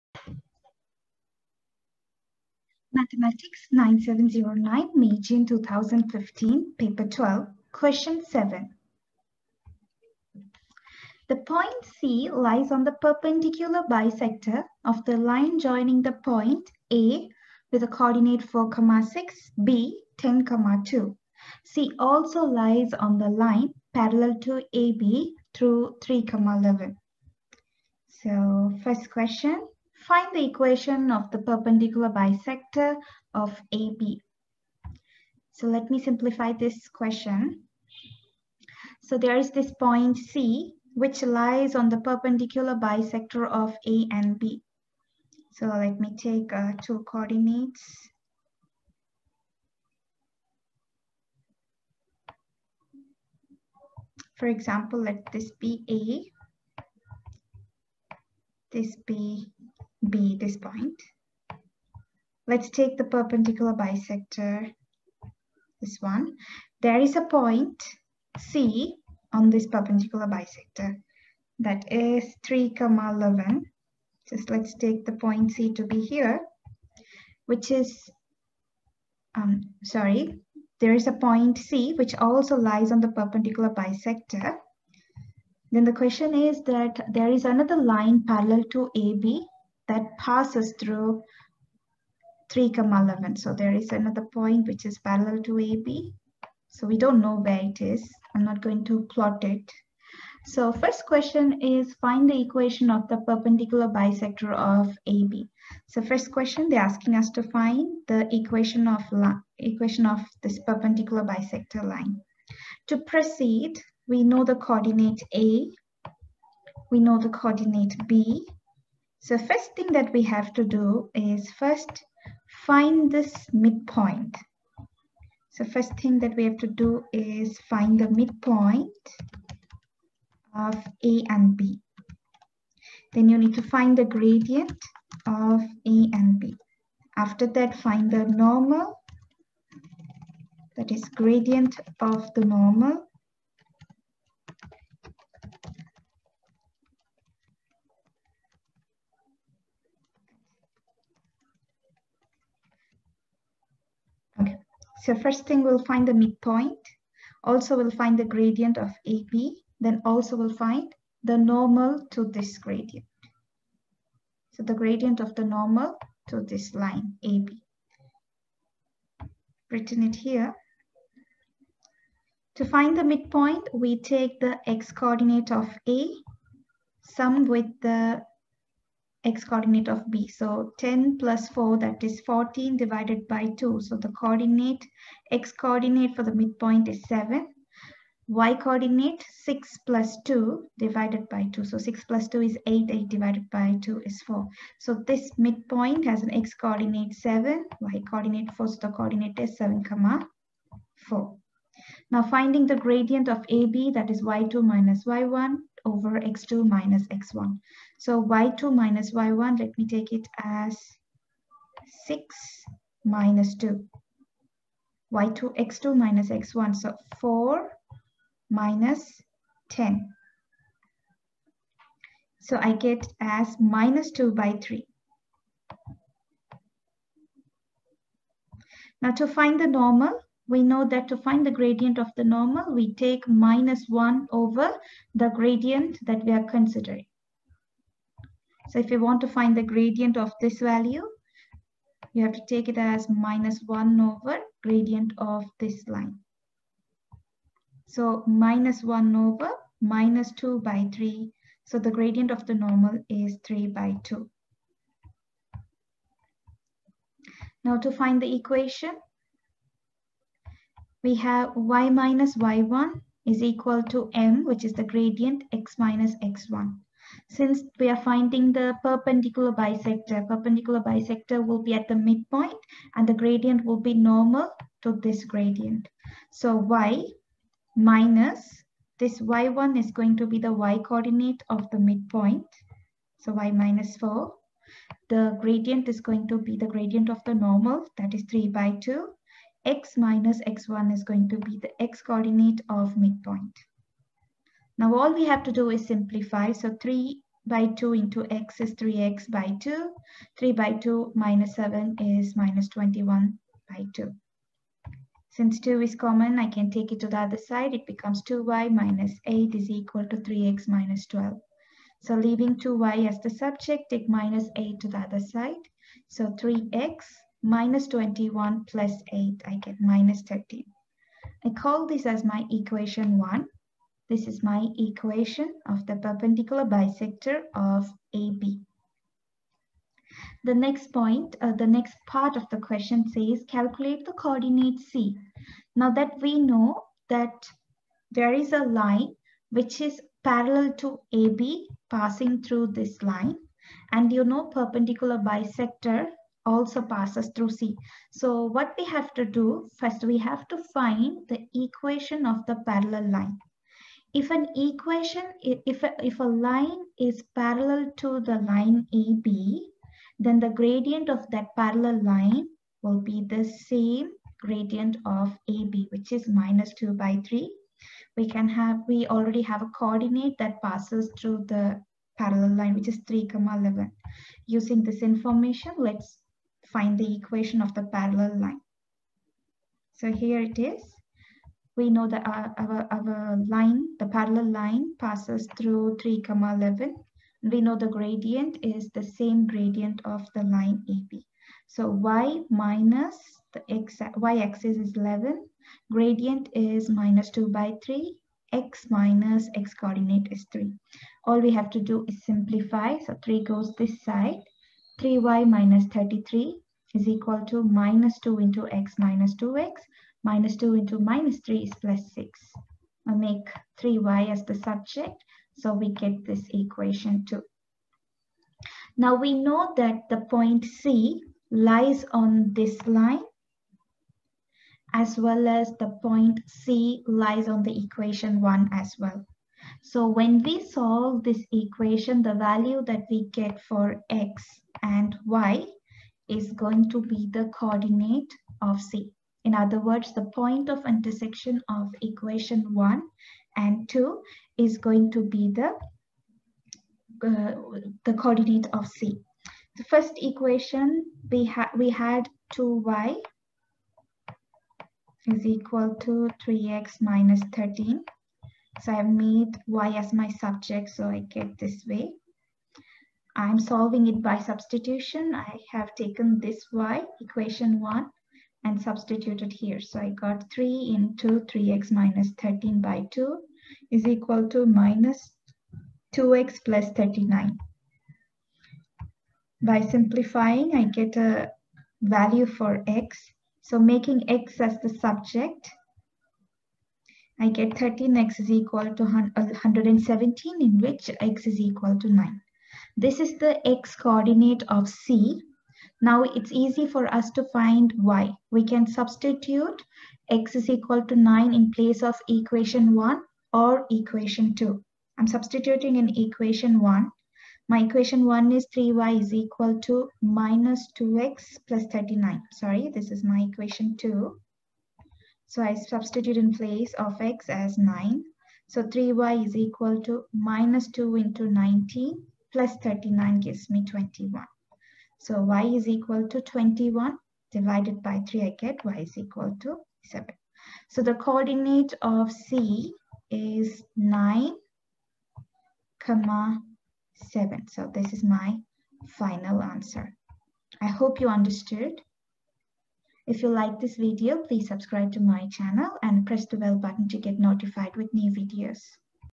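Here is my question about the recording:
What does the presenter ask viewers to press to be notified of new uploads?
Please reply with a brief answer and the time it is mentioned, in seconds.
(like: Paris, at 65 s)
the bell button, at 546 s.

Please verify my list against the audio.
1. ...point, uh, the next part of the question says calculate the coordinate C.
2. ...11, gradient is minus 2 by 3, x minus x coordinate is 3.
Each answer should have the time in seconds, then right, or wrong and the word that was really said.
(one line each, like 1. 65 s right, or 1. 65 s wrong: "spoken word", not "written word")
1. 330 s right
2. 394 s right.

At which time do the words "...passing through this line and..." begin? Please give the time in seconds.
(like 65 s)
341 s.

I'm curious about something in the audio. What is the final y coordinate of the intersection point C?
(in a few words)
7.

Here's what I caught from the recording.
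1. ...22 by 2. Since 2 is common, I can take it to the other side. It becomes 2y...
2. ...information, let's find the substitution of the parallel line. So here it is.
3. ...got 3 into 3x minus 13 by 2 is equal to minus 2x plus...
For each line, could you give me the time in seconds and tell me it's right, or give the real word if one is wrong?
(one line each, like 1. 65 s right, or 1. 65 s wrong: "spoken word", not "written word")
1. 302 s wrong: "21", not "22"
2. 375 s wrong: "equation", not "substitution"
3. 470 s right.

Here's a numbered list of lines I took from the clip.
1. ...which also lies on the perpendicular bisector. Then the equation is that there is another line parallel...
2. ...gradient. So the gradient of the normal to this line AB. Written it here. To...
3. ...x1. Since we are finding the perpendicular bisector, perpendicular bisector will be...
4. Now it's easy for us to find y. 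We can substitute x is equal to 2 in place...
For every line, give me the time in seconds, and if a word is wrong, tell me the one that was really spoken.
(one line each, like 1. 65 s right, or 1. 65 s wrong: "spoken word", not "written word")
1. 81 s wrong: "question", not "equation"
2. 162 s right
3. 266 s right
4. 496 s wrong: "9", not "2".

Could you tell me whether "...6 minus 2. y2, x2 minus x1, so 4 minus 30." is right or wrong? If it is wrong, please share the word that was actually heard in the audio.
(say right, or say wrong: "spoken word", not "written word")
wrong: "10", not "30".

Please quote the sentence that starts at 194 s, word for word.
So this midpoint has an x coordinate 7, y coordinate 4, so the coordinate is 7 comma 4.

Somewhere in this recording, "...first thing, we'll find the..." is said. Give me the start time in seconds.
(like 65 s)
155 s.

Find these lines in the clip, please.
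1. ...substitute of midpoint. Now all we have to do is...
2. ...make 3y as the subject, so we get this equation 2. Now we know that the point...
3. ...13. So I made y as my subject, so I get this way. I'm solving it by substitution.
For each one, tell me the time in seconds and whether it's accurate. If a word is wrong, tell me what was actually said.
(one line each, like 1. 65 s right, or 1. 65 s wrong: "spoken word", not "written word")
1. 292 s wrong: "coordinate", not "substitute"
2. 413 s right
3. 457 s right.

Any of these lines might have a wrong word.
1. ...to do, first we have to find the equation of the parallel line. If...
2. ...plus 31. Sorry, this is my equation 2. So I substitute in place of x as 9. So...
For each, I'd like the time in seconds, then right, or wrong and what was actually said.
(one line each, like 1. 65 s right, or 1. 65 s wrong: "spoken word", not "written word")
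1. 349 s right
2. 511 s wrong: "39", not "31".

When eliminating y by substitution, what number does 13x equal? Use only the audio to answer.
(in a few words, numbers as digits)
117.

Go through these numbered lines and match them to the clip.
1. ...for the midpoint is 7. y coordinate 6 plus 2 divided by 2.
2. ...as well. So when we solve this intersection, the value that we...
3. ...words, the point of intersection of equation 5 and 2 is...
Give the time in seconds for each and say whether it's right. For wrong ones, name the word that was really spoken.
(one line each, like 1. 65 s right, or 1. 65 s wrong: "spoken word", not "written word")
1. 186 s right
2. 428 s wrong: "equation", not "intersection"
3. 439 s wrong: "1", not "5".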